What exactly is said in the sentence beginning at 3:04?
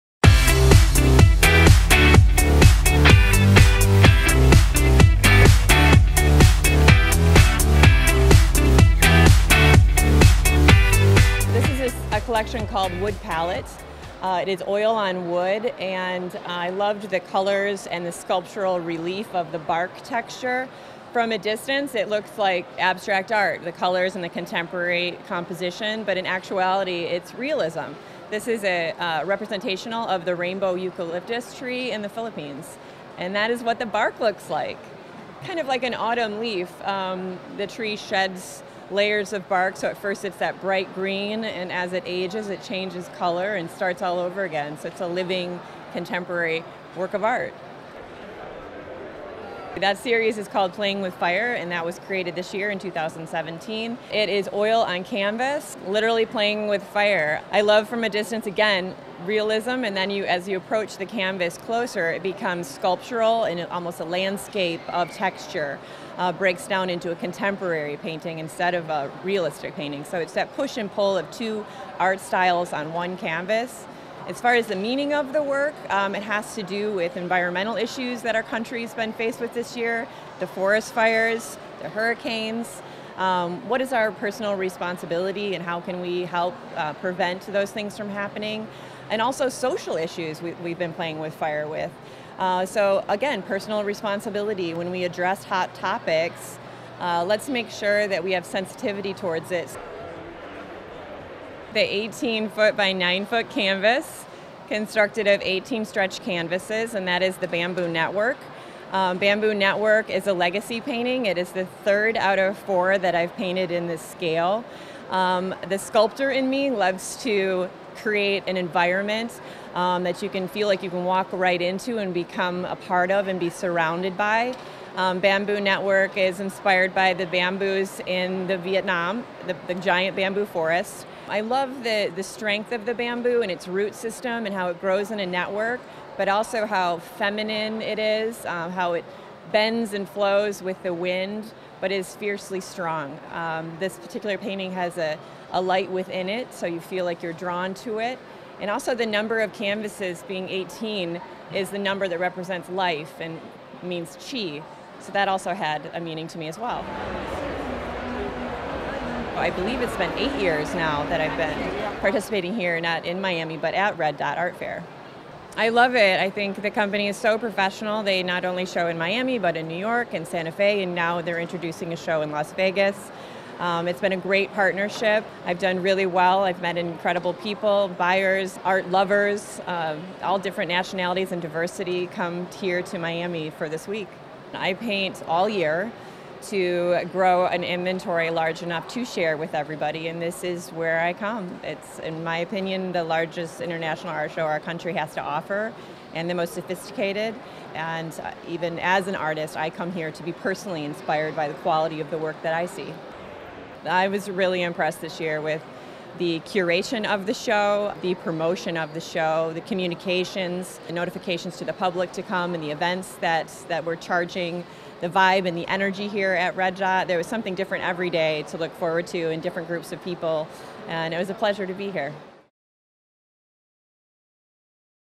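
I paint all year to grow an inventory large enough to share with everybody, and this is where I come.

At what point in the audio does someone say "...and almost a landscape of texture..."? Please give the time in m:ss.
1:03.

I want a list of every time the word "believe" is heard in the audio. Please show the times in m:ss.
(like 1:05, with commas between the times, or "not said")
2:39.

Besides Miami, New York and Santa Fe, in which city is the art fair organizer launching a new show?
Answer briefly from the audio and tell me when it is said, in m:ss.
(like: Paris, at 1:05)
Las Vegas, at 2:52.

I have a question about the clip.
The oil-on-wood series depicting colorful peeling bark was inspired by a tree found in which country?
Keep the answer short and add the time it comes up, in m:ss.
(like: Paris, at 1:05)
Philippines, at 0:32.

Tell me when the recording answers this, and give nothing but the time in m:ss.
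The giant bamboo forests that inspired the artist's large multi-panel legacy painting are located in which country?
2:08.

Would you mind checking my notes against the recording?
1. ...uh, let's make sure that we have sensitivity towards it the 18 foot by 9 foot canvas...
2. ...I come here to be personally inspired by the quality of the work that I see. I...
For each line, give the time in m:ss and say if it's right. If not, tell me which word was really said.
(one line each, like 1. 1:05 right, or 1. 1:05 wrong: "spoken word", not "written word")
1. 1:36 right
2. 3:19 right.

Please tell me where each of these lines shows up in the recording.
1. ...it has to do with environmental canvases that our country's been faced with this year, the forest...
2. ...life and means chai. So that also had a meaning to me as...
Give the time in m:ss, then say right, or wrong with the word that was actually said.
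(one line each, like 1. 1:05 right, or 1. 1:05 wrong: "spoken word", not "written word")
1. 1:16 wrong: "issues", not "canvases"
2. 2:32 right.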